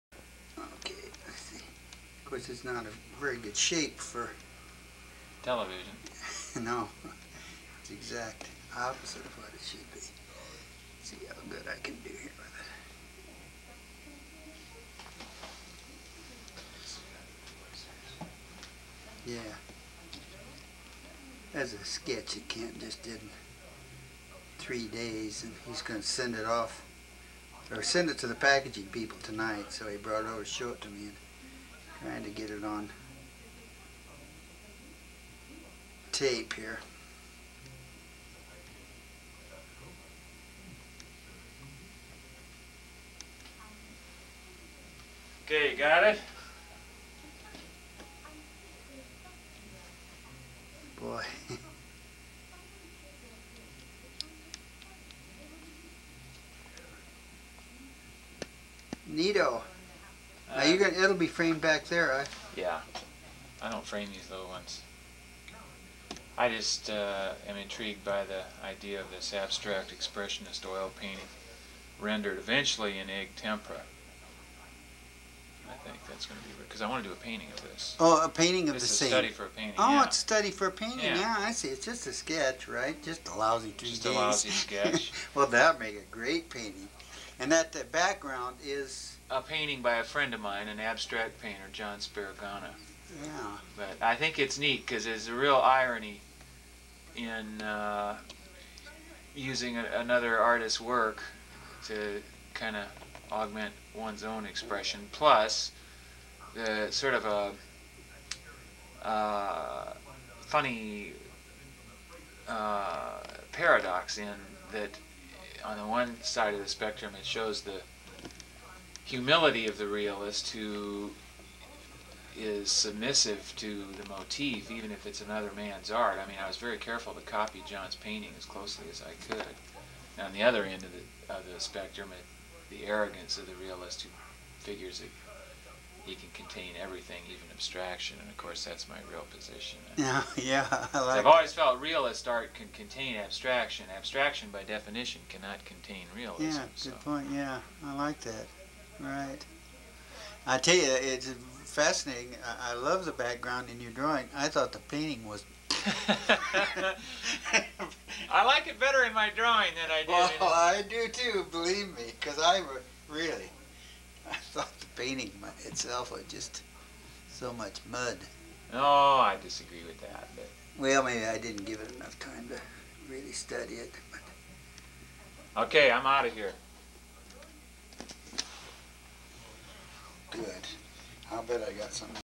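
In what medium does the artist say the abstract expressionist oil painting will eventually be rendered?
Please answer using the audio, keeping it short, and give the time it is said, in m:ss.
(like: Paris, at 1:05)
egg tempera, at 1:13.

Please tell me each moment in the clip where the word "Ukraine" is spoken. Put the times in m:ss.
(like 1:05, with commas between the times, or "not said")
not said.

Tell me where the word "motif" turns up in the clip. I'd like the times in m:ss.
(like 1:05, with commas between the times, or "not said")
2:04.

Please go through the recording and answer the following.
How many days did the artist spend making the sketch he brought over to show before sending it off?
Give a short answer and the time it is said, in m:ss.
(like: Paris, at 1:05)
3, at 0:24.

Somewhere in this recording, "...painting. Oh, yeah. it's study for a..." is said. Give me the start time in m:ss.
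1:19.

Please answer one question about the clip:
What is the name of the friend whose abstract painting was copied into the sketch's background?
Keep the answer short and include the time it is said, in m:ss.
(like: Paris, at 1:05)
John Sparagana, at 1:31.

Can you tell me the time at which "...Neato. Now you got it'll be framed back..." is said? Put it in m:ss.
0:59.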